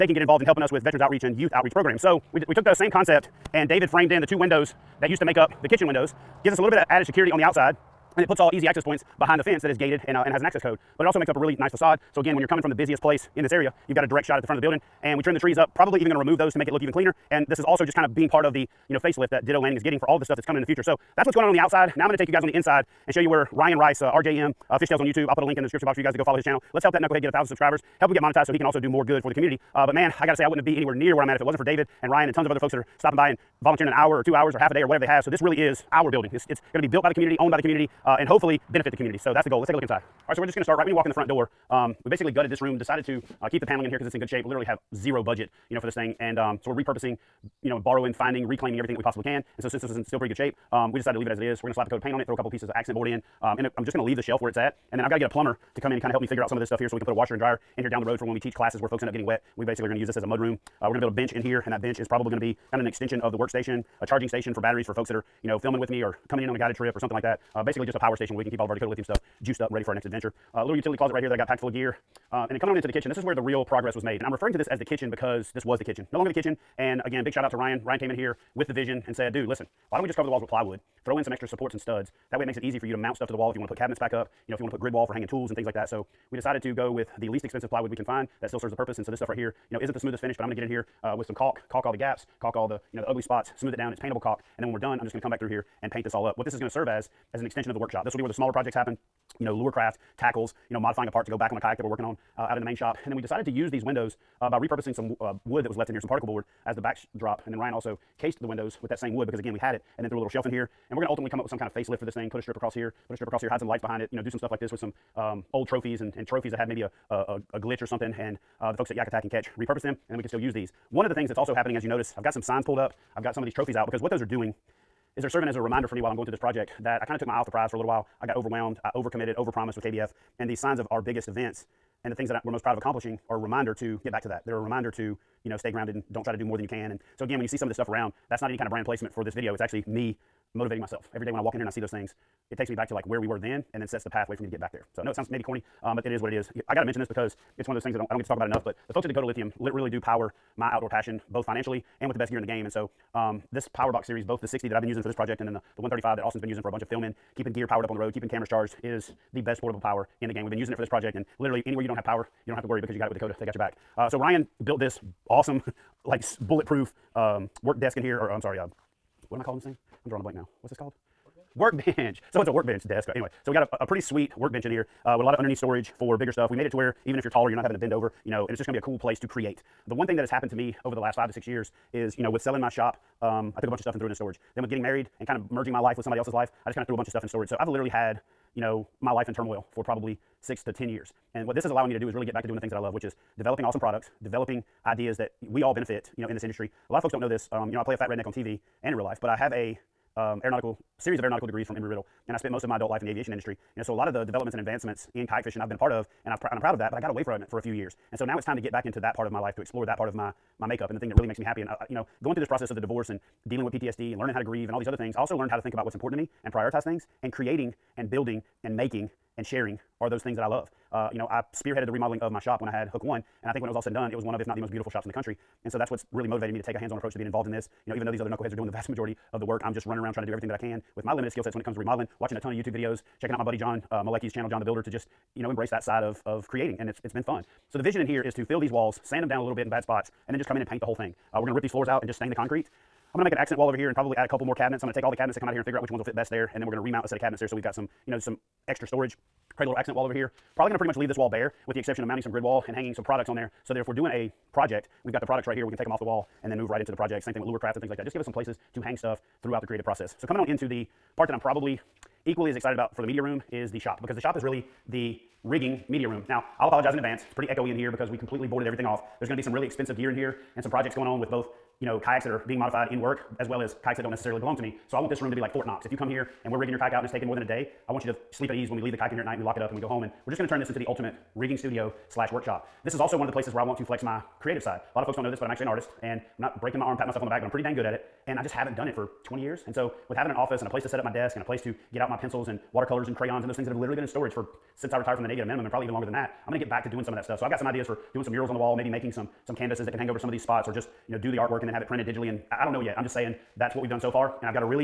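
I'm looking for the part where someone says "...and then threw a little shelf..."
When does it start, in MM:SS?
01:49.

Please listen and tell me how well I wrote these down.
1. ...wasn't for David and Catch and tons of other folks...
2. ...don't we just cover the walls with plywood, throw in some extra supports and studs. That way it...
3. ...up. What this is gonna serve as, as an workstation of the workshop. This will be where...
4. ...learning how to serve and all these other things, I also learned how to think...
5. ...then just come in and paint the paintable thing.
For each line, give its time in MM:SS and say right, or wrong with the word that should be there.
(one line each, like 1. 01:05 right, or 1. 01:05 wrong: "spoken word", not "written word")
1. 00:31 wrong: "Ryan", not "Catch"
2. 01:19 right
3. 01:36 wrong: "extension", not "workstation"
4. 03:34 wrong: "grieve", not "serve"
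5. 04:00 wrong: "whole", not "paintable".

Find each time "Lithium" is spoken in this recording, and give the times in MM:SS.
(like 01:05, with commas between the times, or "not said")
01:08, 02:29.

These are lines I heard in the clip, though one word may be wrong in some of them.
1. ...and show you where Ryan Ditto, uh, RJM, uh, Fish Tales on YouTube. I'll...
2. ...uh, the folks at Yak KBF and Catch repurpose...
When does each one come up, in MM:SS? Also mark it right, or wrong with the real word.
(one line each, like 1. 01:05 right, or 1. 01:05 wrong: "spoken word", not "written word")
1. 00:23 wrong: "Rice", not "Ditto"
2. 01:58 wrong: "Attack", not "KBF".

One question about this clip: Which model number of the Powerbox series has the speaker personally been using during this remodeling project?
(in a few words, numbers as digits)
60.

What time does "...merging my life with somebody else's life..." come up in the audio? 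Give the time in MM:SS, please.
03:05.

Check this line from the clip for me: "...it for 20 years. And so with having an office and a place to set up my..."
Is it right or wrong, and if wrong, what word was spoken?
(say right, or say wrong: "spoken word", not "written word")
right.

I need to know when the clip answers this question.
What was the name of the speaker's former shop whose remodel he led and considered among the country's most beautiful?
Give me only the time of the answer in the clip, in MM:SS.
03:42.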